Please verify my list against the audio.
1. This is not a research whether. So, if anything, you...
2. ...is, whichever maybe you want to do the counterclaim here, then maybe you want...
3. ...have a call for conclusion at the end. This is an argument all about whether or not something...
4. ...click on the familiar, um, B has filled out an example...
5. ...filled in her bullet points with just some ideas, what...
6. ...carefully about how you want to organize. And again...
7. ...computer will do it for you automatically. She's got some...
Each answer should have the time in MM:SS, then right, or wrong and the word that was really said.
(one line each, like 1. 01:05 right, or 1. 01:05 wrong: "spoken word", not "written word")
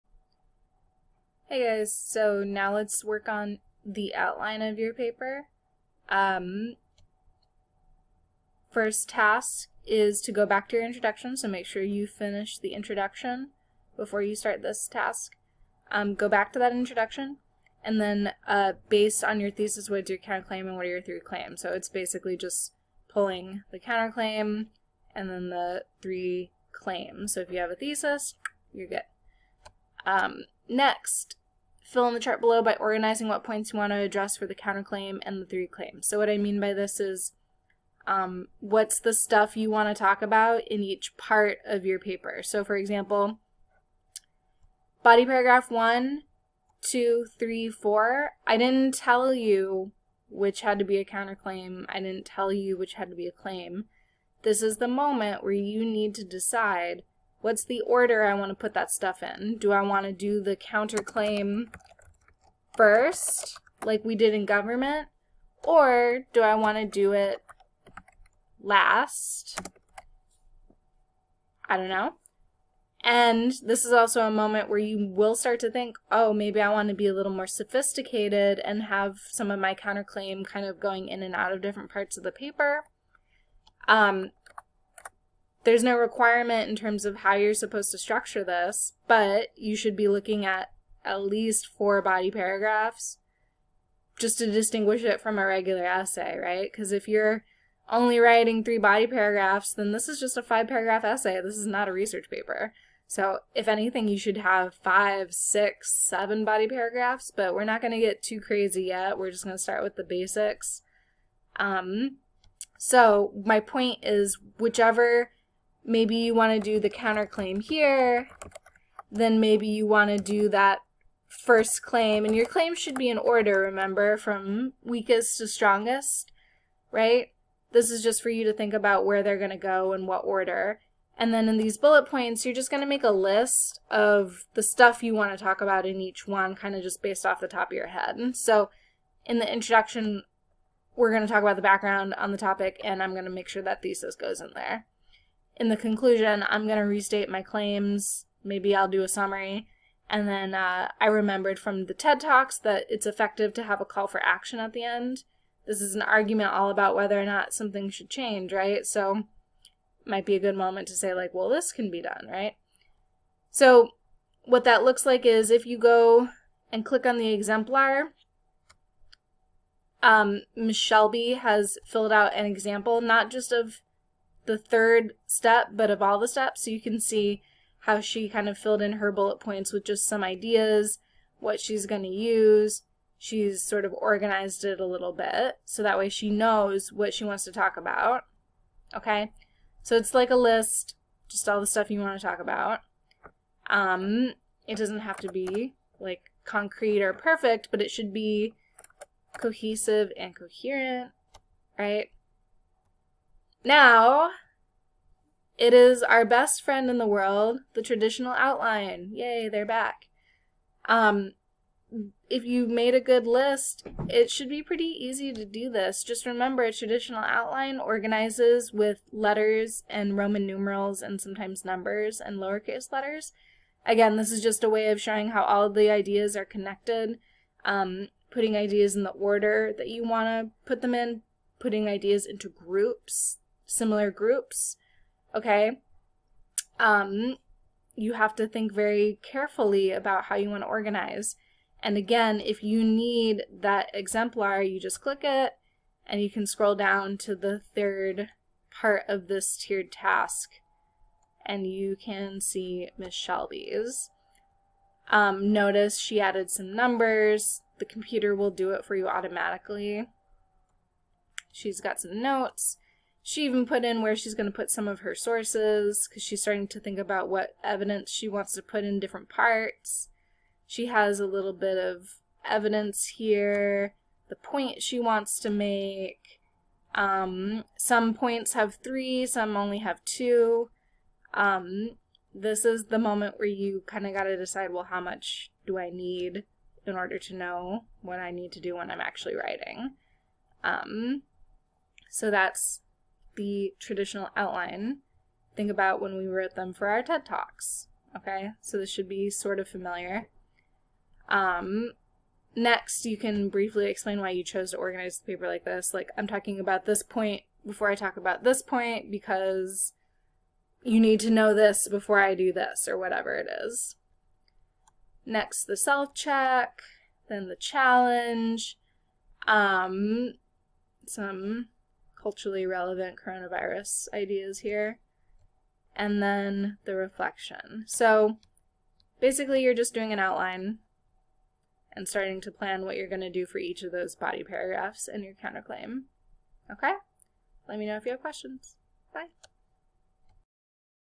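1. 01:41 wrong: "paper", not "whether"
2. 01:54 right
3. 02:33 wrong: "action", not "conclusion"
4. 02:46 wrong: "exemplar", not "familiar"
5. 02:58 right
6. 03:59 right
7. 04:17 right.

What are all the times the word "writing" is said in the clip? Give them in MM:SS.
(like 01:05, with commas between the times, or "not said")
01:38, 04:49.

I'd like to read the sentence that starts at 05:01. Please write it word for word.
Um, next, you can briefly explain why you chose to organize the paper like this.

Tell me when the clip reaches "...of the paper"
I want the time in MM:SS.
01:22.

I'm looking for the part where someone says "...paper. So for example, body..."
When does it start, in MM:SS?
00:41.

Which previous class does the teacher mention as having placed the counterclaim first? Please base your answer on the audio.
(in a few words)
Government.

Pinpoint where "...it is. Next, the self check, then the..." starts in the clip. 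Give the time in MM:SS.
05:13.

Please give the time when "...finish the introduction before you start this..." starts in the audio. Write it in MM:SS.
00:12.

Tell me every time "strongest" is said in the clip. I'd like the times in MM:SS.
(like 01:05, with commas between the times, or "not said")
02:05.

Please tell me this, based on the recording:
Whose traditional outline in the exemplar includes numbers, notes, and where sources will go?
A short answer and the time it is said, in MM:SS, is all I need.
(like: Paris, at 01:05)
Miss Shelby, at 04:12.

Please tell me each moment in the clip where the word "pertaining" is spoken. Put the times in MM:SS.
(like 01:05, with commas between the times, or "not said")
not said.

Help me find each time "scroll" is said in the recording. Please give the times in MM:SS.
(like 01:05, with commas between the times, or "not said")
04:06.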